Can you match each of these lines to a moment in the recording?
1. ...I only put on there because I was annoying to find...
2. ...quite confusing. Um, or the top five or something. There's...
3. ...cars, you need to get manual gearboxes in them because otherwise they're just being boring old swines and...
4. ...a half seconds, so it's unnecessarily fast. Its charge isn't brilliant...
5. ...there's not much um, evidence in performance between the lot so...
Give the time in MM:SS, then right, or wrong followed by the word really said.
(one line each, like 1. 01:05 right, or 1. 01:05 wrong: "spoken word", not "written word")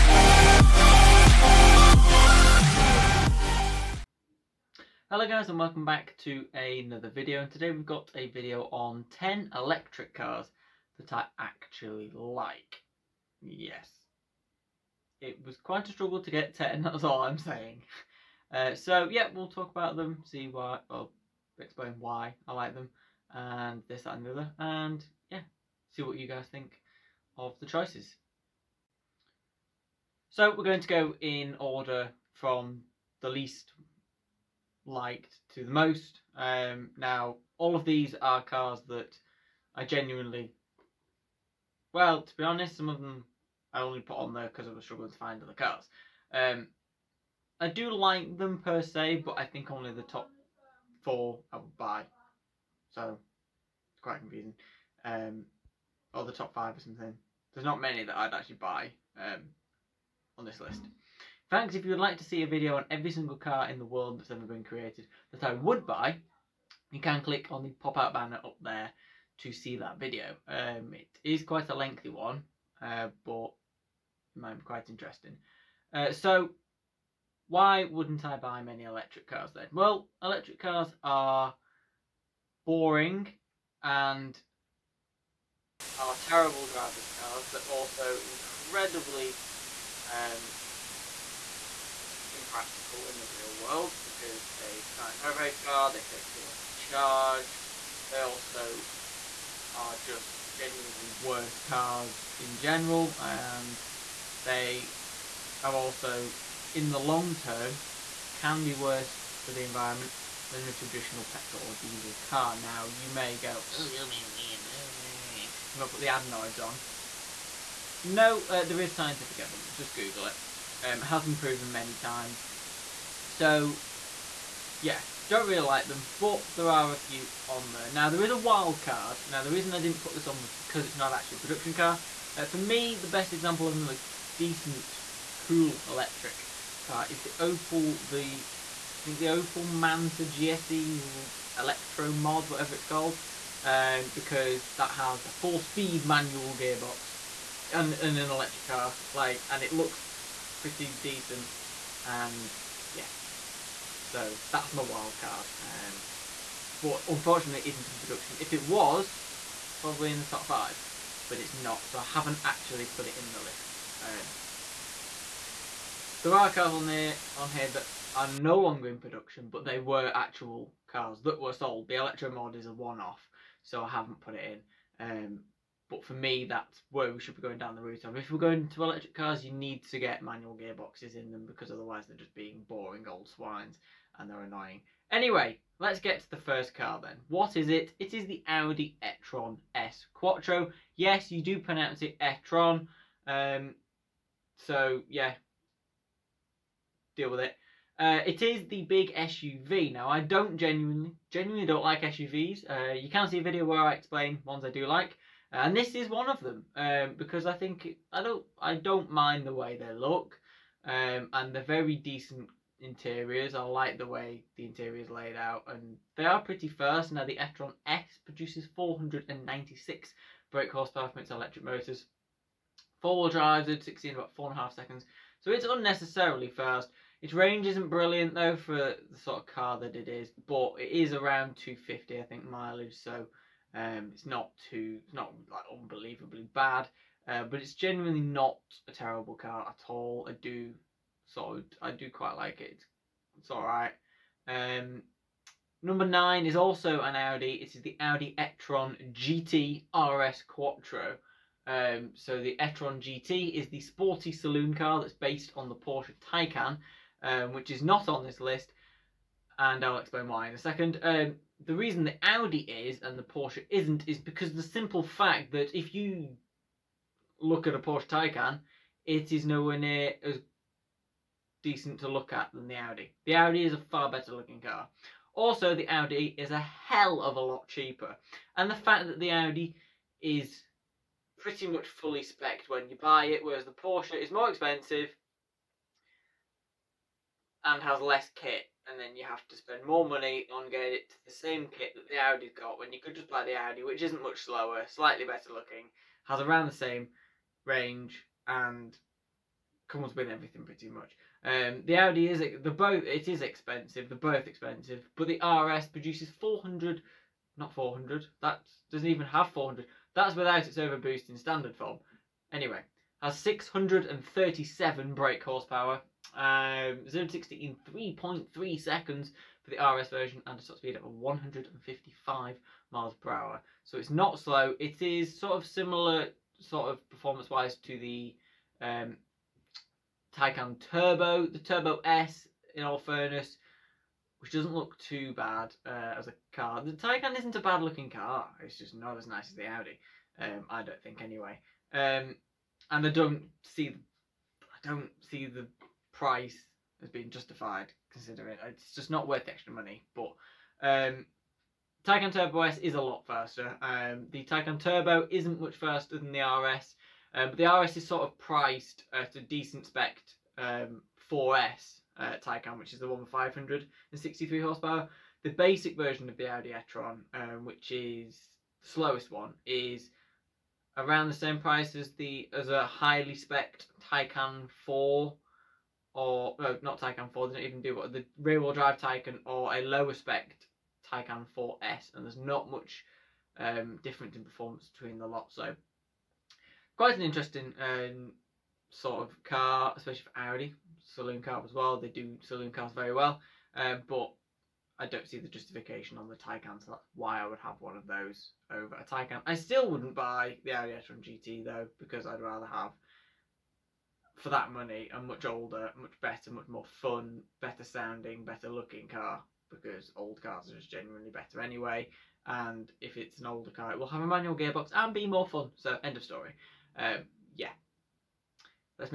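1. 00:43 wrong: "struggling", not "annoying"
2. 00:54 right
3. 02:59 right
4. 03:44 wrong: "range", not "charge"
5. 06:22 wrong: "difference", not "evidence".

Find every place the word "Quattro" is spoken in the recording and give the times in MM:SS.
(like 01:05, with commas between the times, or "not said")
03:10, 04:10.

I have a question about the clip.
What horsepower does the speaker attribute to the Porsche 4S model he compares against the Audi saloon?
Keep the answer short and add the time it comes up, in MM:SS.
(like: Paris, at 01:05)
563, at 06:03.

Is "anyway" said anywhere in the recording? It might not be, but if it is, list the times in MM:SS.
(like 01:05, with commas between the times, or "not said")
03:05, 05:12, 05:41, 06:51.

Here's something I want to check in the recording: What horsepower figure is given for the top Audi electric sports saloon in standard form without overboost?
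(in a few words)
637.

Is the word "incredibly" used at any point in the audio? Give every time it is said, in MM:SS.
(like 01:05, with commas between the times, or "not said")
01:28.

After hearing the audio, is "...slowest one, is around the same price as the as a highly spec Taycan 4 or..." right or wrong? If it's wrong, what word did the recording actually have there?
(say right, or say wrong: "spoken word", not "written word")
right.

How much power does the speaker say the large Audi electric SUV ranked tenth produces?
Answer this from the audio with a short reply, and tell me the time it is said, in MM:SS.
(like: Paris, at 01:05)
496 brake horsepower, at 03:38.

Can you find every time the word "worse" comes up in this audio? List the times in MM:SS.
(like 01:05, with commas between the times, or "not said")
01:41, 01:48.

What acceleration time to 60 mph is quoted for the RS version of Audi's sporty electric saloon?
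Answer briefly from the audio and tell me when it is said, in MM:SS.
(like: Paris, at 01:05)
3.3 seconds, at 05:17.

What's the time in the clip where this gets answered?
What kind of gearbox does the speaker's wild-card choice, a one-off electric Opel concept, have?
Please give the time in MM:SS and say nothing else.
02:25.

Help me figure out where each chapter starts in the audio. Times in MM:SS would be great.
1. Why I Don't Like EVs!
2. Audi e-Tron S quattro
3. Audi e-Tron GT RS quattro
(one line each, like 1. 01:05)
1. 00:30
2. 03:08
3. 04:08.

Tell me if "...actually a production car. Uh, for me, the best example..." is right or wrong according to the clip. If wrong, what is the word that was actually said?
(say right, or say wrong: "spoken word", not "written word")
right.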